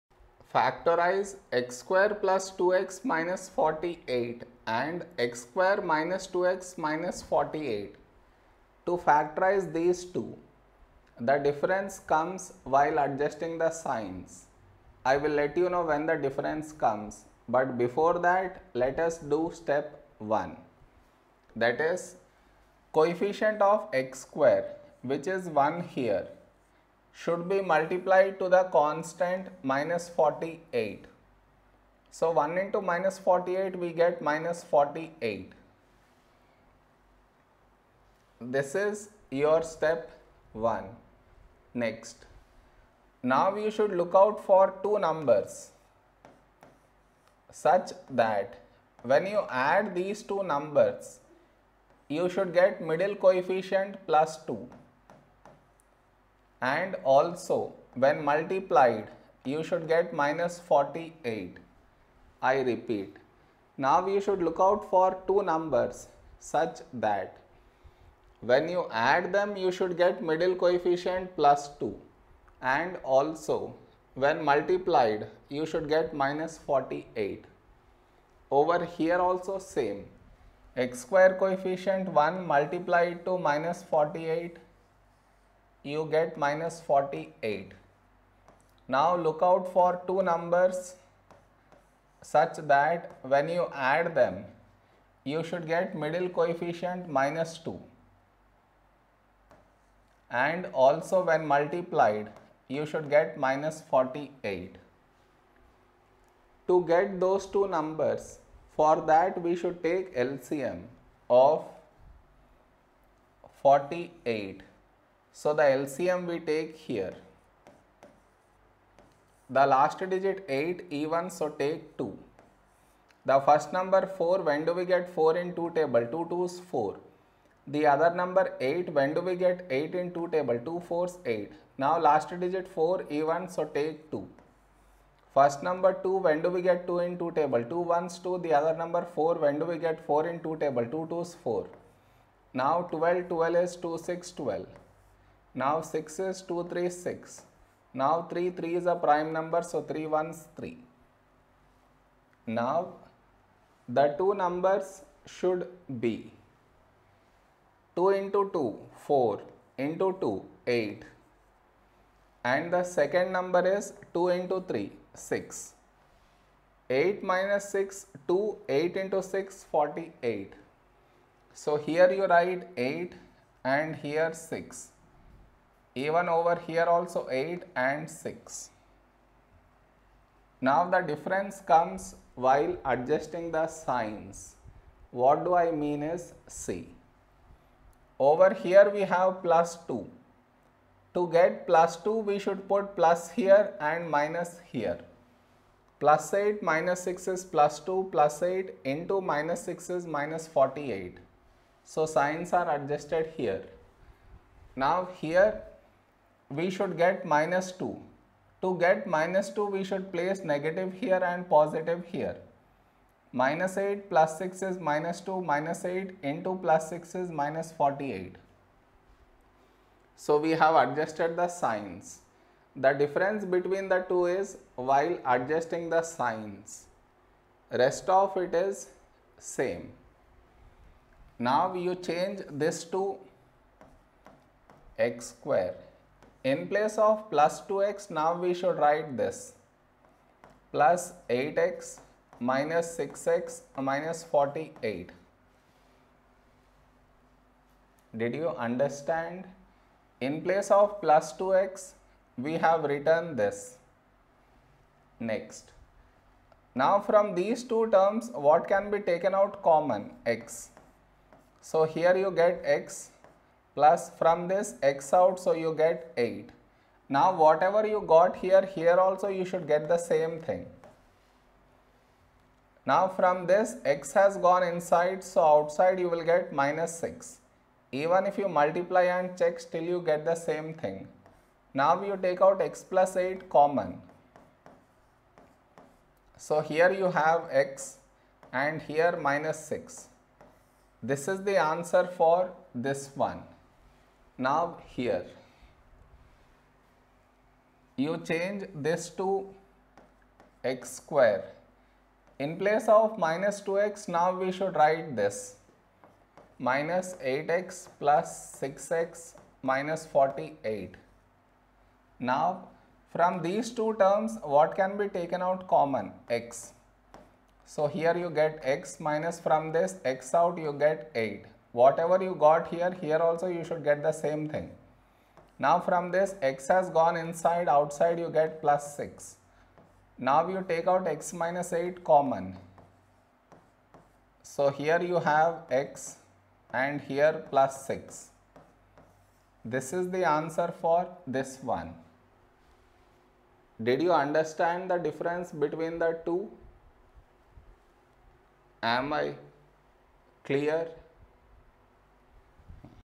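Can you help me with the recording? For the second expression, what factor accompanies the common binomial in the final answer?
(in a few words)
x + 6.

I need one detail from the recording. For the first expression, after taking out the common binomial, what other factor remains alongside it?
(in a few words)
x - 6.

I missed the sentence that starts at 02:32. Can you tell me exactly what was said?
Now the two numbers should be 2 into 2, 4 into 2, 8.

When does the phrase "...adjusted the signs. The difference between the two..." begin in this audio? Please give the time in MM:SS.
03:40.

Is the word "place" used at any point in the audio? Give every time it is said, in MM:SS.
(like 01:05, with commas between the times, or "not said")
03:30, 03:56, 04:10, 05:02.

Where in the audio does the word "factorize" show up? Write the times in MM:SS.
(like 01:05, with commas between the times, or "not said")
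00:00, 00:08.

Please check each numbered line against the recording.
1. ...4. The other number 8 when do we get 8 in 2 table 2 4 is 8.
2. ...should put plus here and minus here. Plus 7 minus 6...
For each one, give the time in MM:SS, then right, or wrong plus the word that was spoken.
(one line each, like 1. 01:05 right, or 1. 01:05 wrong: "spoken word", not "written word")
1. 02:06 right
2. 03:12 wrong: "8", not "7".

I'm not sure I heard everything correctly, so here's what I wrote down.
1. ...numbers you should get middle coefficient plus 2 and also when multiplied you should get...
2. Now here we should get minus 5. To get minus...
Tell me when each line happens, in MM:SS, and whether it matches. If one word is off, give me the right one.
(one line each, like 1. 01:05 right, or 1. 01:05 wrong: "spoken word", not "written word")
1. 00:50 right
2. 03:24 wrong: "2", not "5".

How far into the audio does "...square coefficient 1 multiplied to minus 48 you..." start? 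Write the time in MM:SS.
01:21.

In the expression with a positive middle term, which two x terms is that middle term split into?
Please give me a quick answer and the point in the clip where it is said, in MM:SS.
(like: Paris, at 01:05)
+8x - 6x, at 04:00.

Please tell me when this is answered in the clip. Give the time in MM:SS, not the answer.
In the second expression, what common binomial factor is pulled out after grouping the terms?
05:31.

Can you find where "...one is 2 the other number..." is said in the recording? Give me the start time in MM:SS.
02:17.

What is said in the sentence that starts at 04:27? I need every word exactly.
Now whatever you got here, here also you should get the same thing.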